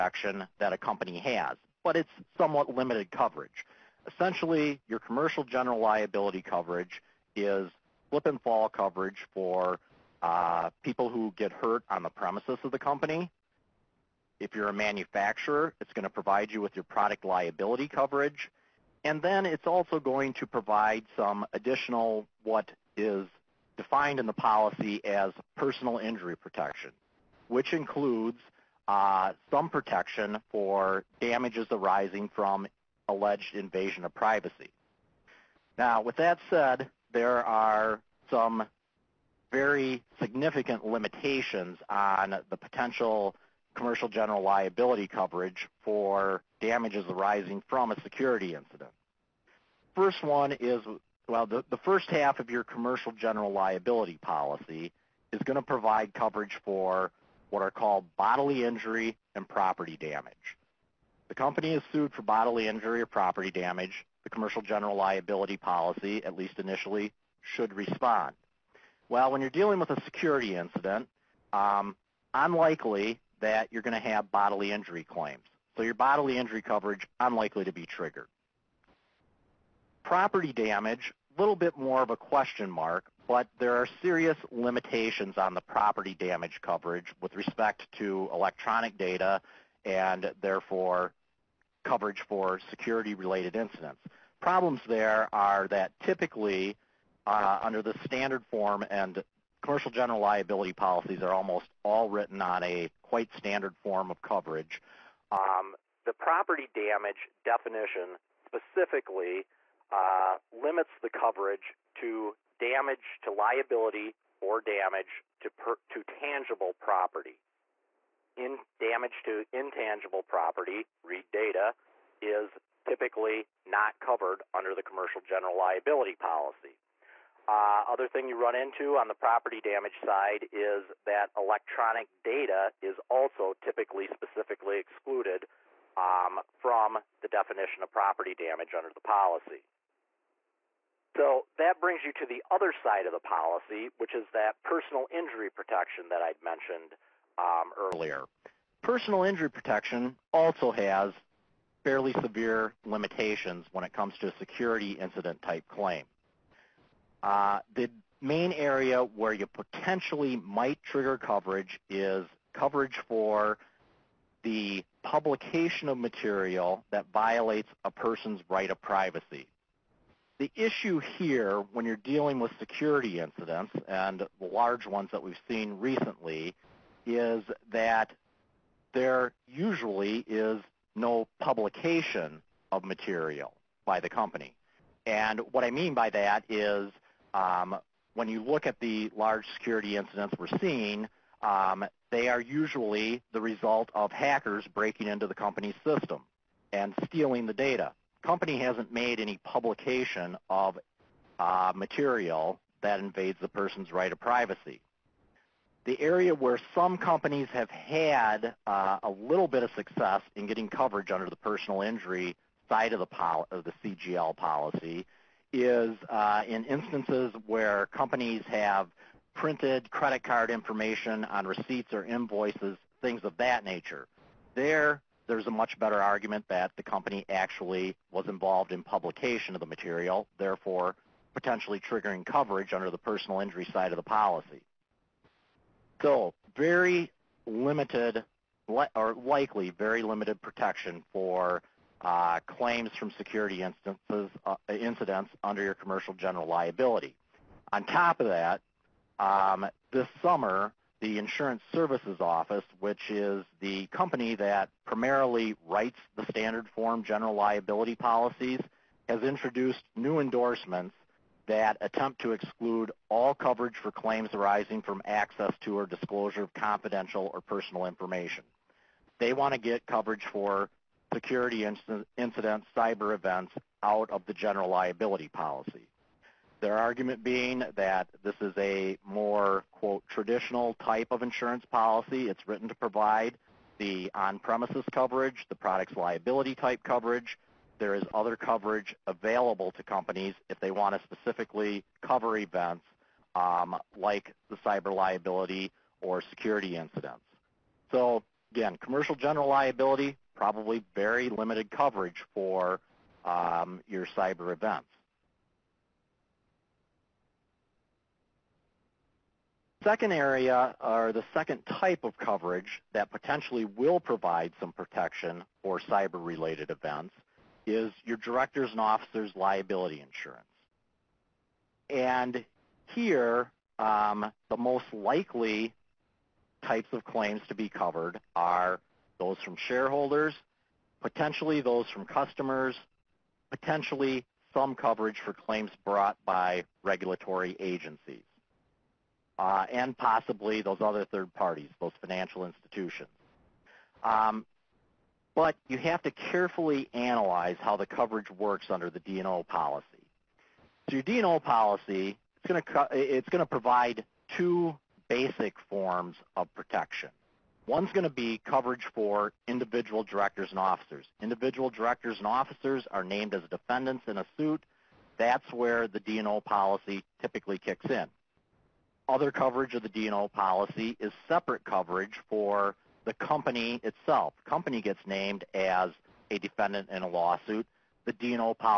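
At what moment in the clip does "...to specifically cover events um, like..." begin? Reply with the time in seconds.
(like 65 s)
290 s.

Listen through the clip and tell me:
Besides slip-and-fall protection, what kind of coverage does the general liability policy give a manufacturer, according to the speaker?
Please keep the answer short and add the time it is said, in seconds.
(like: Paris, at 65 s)
Product liability coverage, at 16 s.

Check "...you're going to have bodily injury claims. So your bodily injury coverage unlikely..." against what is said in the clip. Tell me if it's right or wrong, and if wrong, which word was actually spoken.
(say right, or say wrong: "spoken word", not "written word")
right.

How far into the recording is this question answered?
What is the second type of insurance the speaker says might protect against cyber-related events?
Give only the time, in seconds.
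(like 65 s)
318 s.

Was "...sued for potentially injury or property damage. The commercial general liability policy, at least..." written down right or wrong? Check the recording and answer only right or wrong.
wrong.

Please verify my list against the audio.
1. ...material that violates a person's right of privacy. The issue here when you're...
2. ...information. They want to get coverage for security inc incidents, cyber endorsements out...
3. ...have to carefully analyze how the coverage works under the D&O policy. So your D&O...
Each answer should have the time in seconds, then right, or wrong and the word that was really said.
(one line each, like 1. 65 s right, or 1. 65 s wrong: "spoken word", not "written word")
1. 165 s right
2. 267 s wrong: "events", not "endorsements"
3. 345 s right.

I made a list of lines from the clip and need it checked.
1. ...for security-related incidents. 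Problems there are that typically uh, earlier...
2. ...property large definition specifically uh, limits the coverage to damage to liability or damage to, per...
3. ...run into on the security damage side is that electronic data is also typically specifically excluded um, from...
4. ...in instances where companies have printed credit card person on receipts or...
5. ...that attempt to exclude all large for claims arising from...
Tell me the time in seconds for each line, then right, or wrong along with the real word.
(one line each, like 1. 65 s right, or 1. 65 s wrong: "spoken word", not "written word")
1. 92 s wrong: "under", not "earlier"
2. 106 s wrong: "damage", not "large"
3. 128 s wrong: "property", not "security"
4. 216 s wrong: "information", not "person"
5. 261 s wrong: "coverage", not "large".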